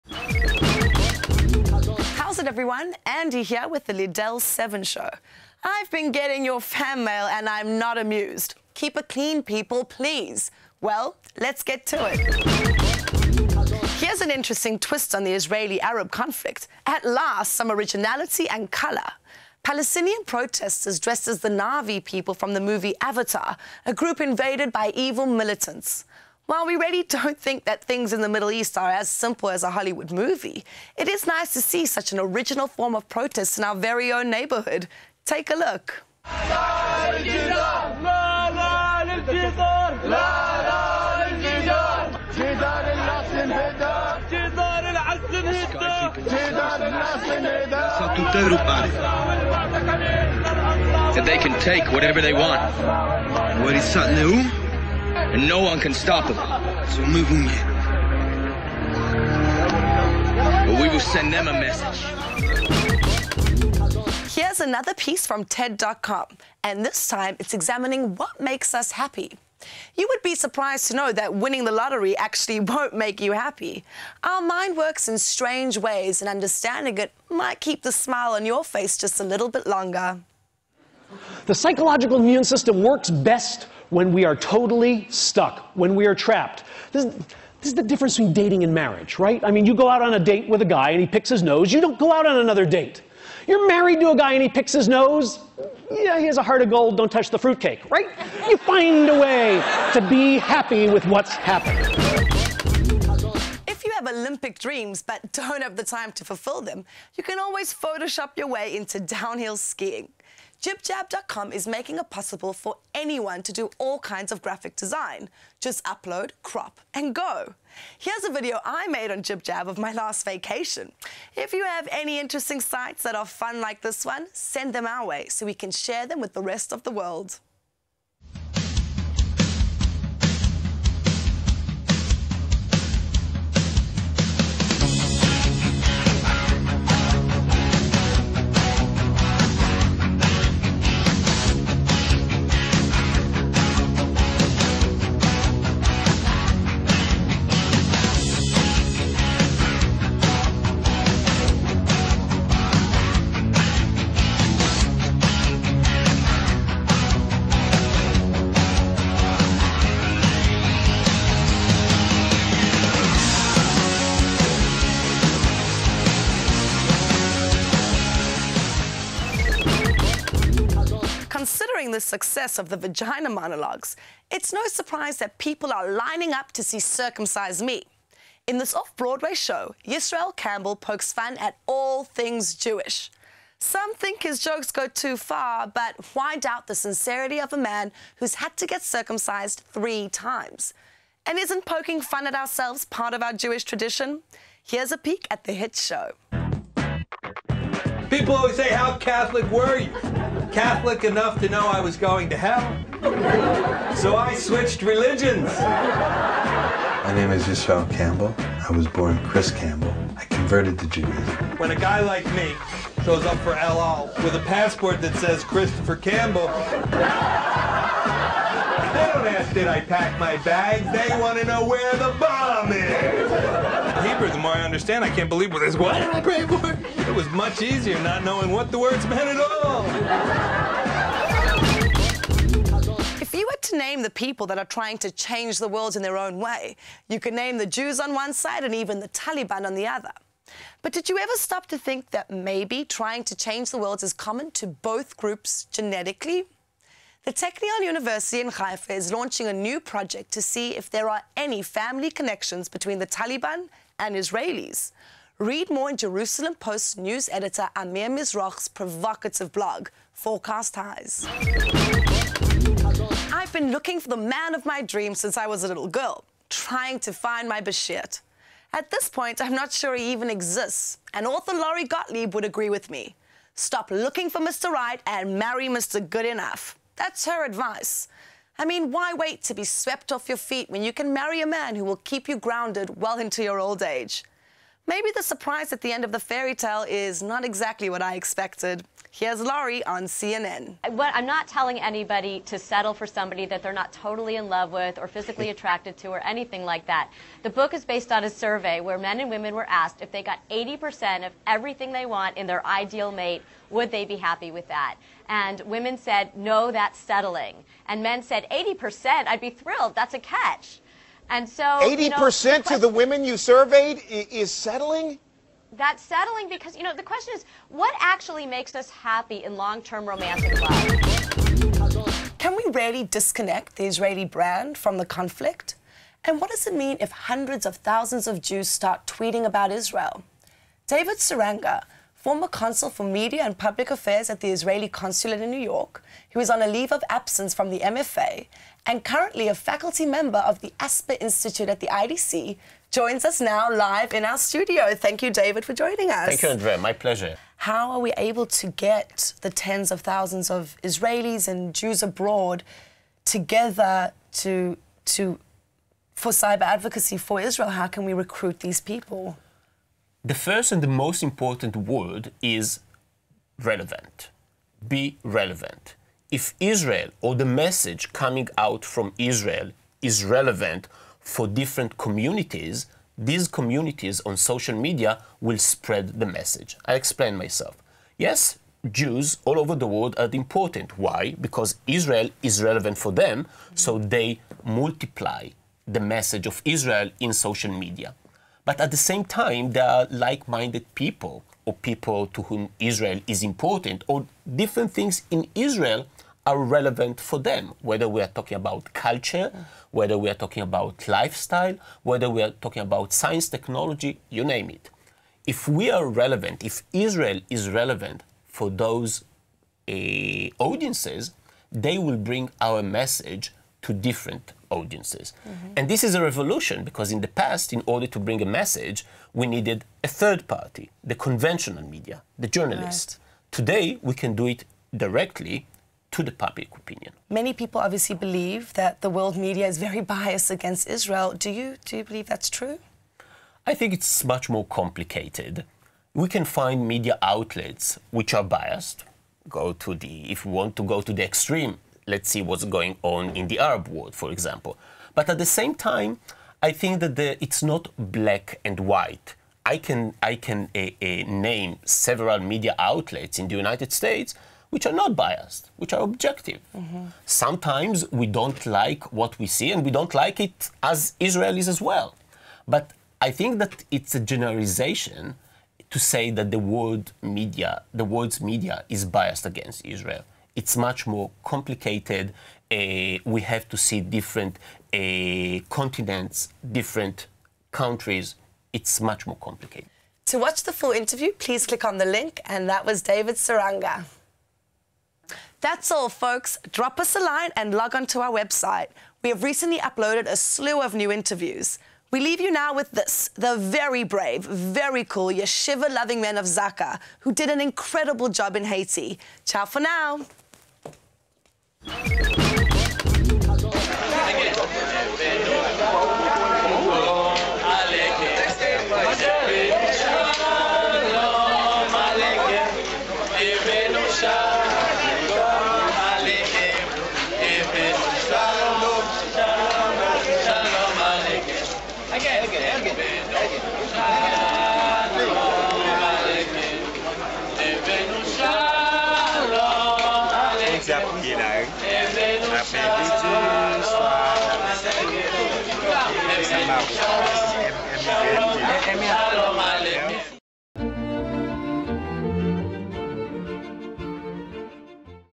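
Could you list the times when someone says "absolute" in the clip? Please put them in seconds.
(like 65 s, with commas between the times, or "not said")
not said.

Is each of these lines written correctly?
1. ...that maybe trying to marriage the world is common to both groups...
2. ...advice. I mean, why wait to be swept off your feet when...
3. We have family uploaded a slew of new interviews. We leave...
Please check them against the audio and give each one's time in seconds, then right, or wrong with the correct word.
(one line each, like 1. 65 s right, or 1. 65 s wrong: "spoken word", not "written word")
1. 242 s wrong: "change", not "marriage"
2. 277 s right
3. 489 s wrong: "recently", not "family".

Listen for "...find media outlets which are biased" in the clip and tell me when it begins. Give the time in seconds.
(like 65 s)
436 s.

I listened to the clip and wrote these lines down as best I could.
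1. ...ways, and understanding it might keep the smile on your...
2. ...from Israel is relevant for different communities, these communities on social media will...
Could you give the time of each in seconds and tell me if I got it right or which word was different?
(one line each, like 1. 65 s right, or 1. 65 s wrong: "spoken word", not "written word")
1. 75 s right
2. 368 s right.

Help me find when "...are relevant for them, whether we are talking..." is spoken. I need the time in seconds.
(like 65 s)
396 s.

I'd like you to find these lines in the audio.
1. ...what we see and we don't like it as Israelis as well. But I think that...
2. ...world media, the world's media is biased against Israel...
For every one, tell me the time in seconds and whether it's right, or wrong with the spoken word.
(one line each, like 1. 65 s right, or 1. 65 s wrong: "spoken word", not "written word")
1. 459 s right
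2. 466 s right.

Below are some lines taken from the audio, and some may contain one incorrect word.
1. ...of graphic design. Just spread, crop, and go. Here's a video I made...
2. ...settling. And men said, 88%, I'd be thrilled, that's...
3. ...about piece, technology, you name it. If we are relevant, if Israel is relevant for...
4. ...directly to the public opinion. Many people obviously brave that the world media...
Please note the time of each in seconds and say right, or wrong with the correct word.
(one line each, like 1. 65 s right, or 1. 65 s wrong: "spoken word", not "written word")
1. 114 s wrong: "upload", not "spread"
2. 306 s wrong: "80", not "88"
3. 402 s wrong: "science", not "piece"
4. 424 s wrong: "believe", not "brave".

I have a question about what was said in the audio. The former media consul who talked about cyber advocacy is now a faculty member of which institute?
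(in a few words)
Asper Institute.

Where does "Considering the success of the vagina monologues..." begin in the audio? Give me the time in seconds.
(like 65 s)
171 s.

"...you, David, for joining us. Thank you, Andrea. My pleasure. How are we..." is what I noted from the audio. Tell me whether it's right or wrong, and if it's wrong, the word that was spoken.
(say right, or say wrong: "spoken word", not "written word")
right.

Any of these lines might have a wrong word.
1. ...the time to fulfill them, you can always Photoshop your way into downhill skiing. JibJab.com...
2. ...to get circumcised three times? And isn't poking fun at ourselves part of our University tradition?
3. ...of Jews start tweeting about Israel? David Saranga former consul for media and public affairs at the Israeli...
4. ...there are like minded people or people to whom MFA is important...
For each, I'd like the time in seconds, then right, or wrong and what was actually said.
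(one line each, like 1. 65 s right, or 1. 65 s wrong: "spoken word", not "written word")
1. 105 s right
2. 188 s wrong: "Jewish", not "University"
3. 328 s right
4. 389 s wrong: "Israel", not "MFA".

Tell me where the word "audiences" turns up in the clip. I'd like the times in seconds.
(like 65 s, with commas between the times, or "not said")
410 s, 414 s.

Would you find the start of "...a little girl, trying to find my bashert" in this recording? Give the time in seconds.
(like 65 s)
265 s.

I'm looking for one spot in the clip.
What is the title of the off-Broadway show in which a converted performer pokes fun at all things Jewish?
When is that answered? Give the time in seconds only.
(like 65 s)
176 s.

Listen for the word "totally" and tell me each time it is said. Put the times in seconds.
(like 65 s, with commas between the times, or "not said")
84 s, 293 s.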